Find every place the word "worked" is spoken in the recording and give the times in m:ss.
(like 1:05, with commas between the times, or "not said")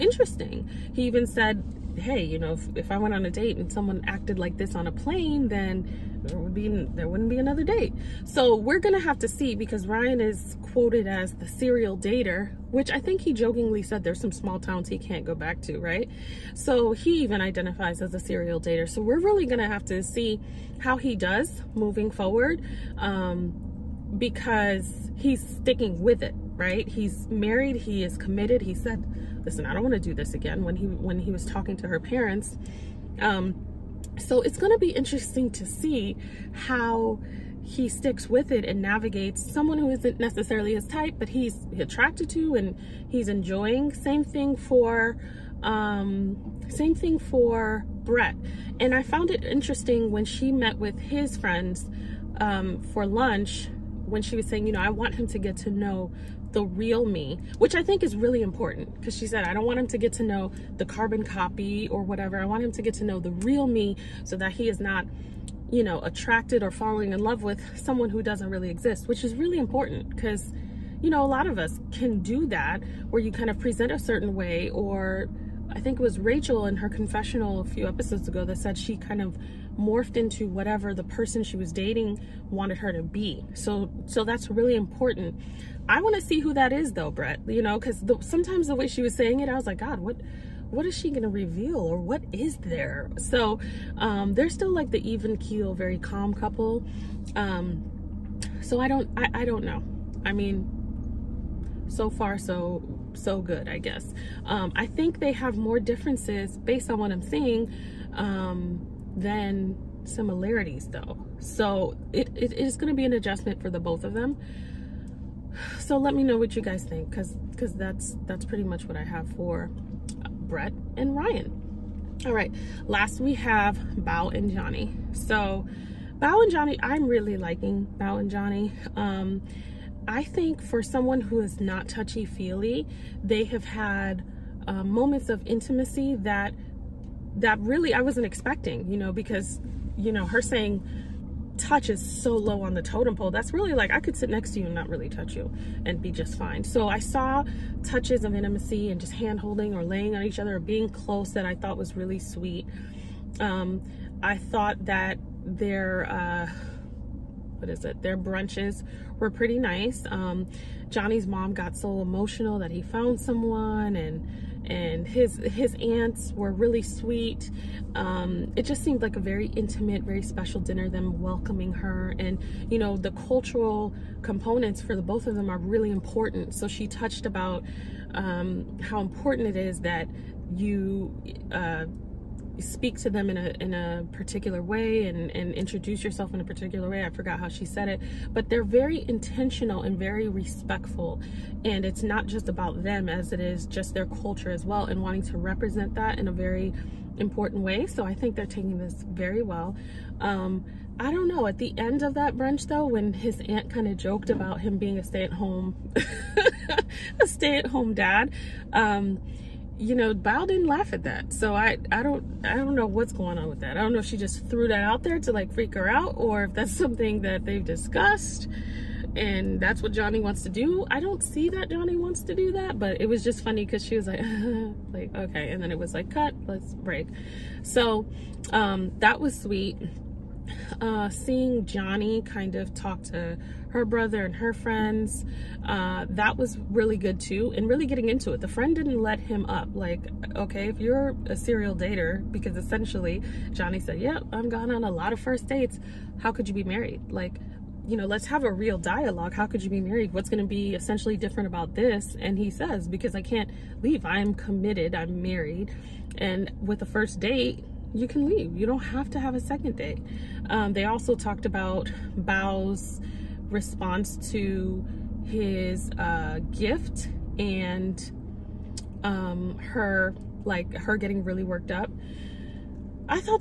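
4:31.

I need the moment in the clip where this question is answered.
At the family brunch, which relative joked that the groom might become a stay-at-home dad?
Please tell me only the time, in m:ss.
3:23.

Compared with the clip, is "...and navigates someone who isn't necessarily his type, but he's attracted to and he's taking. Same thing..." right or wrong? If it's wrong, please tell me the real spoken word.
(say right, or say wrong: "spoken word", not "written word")
wrong: "enjoying", not "taking".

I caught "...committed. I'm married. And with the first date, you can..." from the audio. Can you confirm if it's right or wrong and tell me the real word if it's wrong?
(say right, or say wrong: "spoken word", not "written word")
right.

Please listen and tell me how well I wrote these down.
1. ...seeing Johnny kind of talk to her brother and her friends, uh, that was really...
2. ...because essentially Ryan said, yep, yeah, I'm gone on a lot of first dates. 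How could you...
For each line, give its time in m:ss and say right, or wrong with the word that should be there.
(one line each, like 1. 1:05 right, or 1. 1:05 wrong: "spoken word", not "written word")
1. 3:51 right
2. 4:02 wrong: "Johnny", not "Ryan".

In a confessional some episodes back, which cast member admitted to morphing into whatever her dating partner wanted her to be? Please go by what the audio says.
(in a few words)
Rachel.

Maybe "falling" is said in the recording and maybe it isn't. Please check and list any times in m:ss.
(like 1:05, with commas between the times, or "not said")
1:06.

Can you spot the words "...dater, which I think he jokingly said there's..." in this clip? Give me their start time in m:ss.
0:11.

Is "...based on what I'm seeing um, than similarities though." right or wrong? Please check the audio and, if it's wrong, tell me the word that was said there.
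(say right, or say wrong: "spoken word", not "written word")
right.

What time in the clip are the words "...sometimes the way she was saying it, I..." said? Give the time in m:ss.
1:28.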